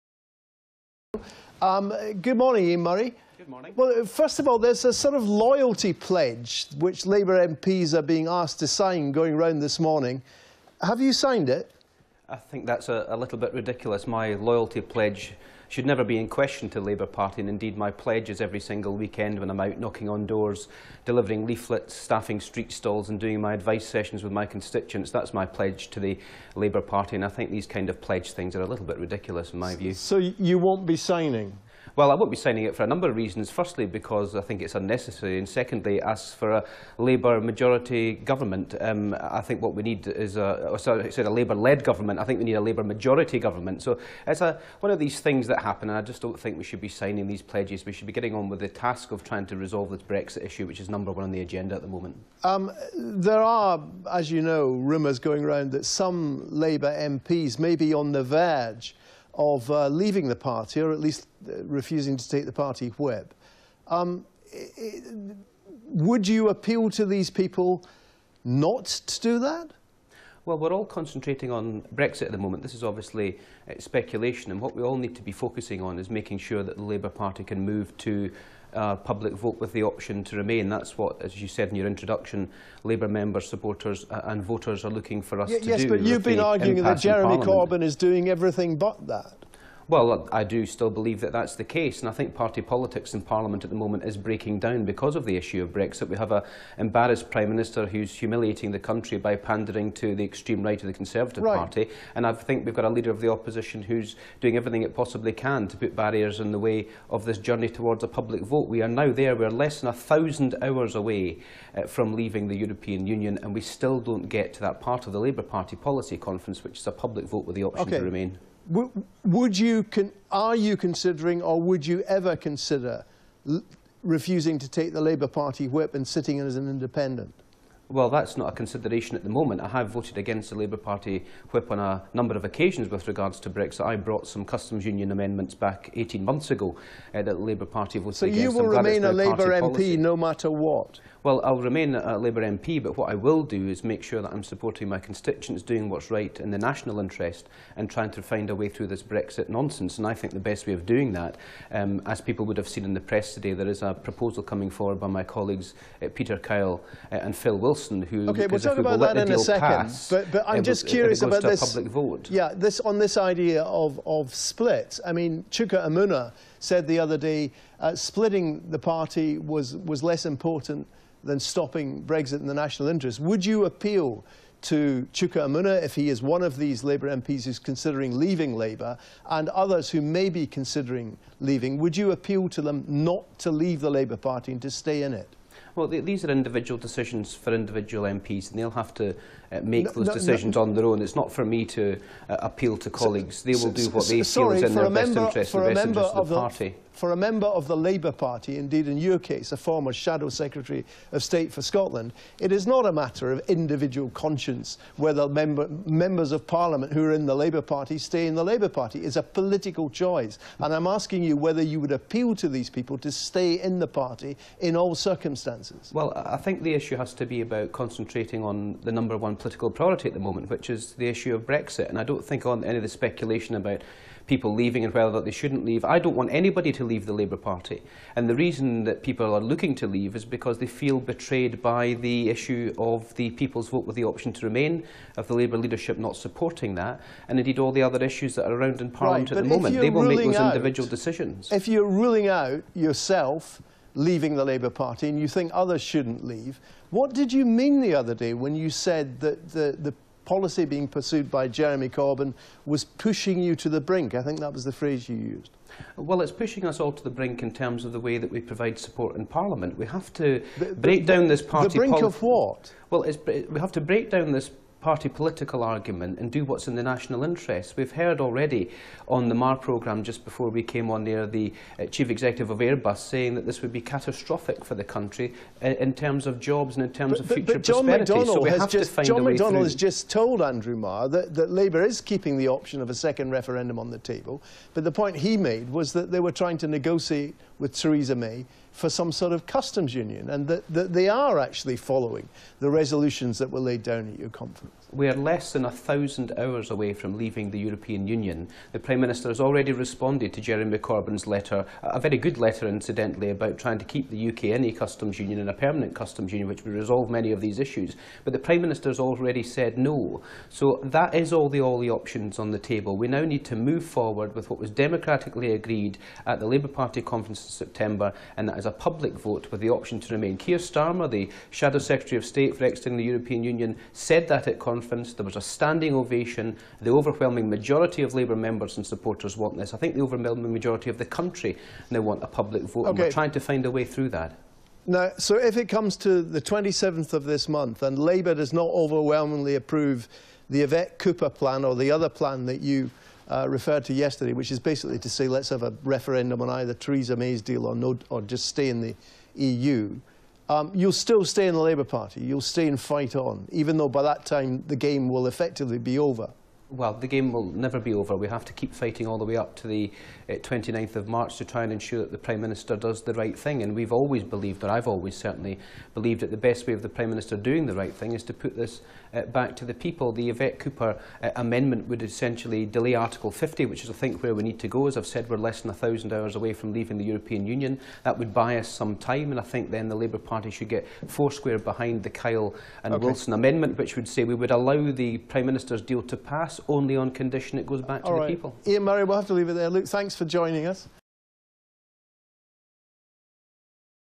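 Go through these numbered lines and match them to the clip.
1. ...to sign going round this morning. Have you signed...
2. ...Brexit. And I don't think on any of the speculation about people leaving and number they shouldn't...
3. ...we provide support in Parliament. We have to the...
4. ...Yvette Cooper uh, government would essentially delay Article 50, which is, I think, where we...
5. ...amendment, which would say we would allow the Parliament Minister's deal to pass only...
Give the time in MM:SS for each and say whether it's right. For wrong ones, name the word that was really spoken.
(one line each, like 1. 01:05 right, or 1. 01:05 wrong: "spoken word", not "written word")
1. 00:08 right
2. 03:41 wrong: "whether", not "number"
3. 04:18 right
4. 06:10 wrong: "amendment", not "government"
5. 06:23 wrong: "Prime", not "Parliament".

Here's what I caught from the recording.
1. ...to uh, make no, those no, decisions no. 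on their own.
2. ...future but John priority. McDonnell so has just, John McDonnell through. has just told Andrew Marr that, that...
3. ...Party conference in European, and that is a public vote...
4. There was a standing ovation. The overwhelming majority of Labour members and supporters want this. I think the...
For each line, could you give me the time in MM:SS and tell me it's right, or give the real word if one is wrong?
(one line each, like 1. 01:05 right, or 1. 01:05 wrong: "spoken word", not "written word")
1. 03:08 right
2. 04:37 wrong: "prosperity", not "priority"
3. 05:16 wrong: "September", not "European"
4. 05:25 right.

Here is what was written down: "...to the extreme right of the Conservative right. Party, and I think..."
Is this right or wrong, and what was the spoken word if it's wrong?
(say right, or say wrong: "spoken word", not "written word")
right.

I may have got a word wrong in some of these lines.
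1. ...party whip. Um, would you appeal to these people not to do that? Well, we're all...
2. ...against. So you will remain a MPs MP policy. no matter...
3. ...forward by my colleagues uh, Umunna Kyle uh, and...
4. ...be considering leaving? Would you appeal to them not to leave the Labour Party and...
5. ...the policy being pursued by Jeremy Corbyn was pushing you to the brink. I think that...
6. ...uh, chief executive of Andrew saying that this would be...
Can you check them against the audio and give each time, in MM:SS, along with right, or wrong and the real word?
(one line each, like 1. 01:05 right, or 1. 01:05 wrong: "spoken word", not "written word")
1. 01:02 right
2. 02:18 wrong: "Labour", not "MPs"
3. 02:34 wrong: "Peter", not "Umunna"
4. 03:00 right
5. 04:09 right
6. 04:31 wrong: "Airbus", not "Andrew".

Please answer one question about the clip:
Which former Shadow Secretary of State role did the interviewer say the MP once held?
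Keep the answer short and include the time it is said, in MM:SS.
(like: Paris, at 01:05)
Shadow Secretary of State for Scotland, at 03:19.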